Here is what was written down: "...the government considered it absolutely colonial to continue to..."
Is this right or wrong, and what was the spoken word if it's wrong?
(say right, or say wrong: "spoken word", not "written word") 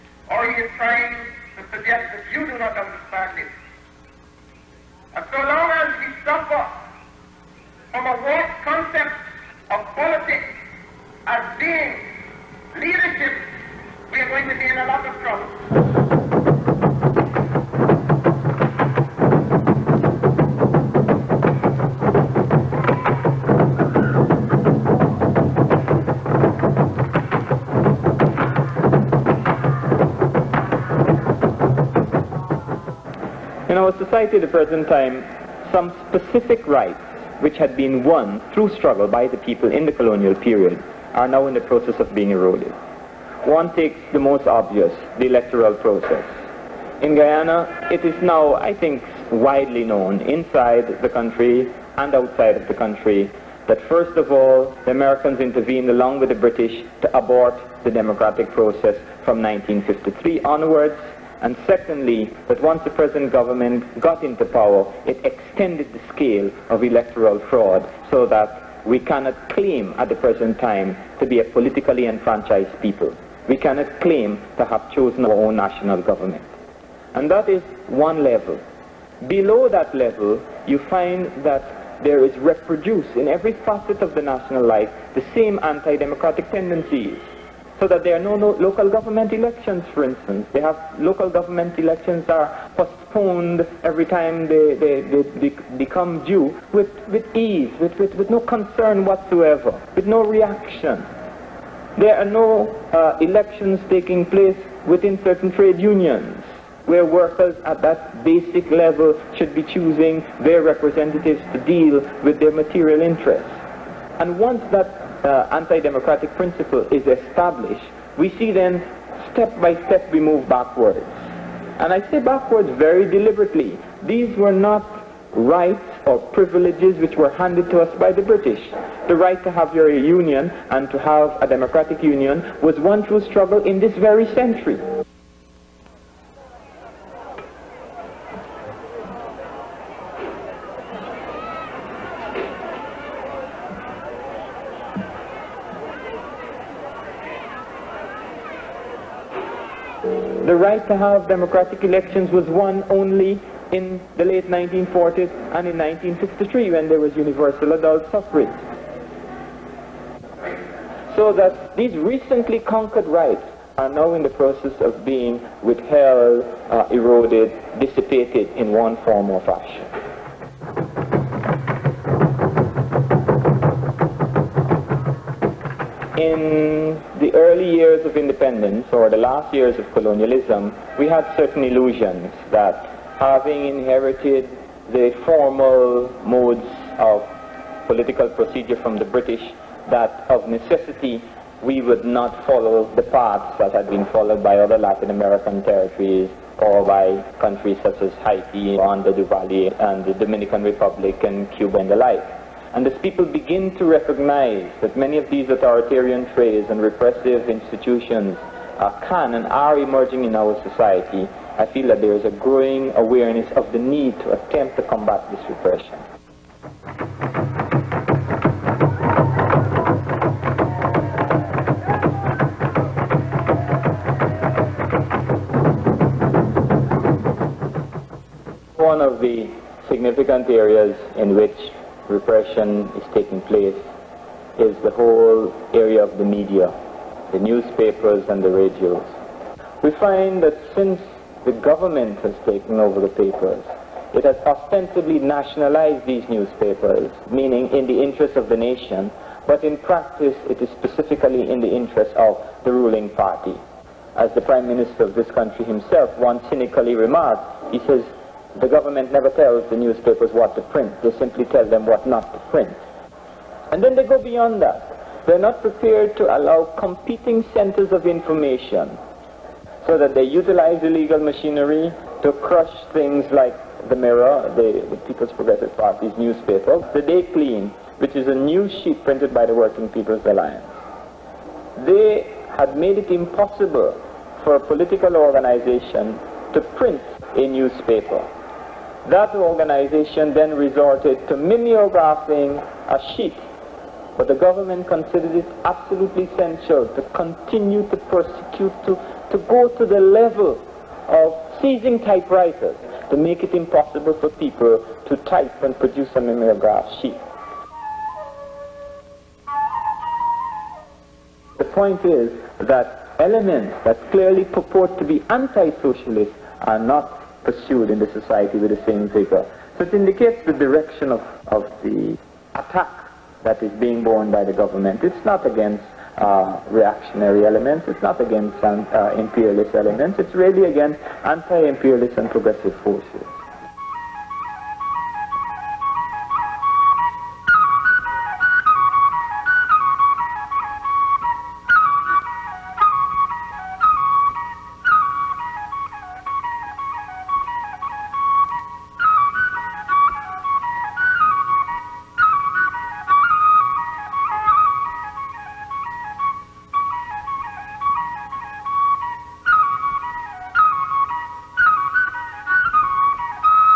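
wrong: "essential", not "colonial".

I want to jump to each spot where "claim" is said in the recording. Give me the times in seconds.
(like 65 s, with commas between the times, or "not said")
69 s, 74 s.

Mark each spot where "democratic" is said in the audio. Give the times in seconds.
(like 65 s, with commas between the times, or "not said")
57 s, 85 s, 115 s, 131 s, 151 s.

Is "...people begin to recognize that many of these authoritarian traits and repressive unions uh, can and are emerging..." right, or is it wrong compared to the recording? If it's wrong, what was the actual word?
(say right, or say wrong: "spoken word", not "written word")
wrong: "institutions", not "unions".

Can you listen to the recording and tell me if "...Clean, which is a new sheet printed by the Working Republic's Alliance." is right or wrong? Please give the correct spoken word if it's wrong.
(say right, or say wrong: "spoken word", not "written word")
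wrong: "People", not "Republic".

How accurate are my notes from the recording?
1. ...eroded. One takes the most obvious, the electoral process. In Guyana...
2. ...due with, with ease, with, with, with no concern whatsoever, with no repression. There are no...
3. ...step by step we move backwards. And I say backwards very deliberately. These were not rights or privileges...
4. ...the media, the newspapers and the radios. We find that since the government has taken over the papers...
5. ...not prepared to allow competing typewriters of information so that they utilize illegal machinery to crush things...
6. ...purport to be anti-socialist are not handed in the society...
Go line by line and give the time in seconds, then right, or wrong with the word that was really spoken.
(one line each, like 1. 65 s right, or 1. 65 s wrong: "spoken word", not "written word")
1. 42 s right
2. 96 s wrong: "reaction", not "repression"
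3. 119 s right
4. 236 s right
5. 265 s wrong: "centers", not "typewriters"
6. 314 s wrong: "pursued", not "handed".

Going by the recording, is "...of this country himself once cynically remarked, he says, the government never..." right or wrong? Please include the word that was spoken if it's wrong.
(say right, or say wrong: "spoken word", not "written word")
right.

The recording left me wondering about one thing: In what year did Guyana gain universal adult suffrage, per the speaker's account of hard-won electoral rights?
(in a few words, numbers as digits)
1963.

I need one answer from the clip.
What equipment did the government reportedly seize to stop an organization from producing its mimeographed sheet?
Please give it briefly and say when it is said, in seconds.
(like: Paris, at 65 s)
typewriters, at 302 s.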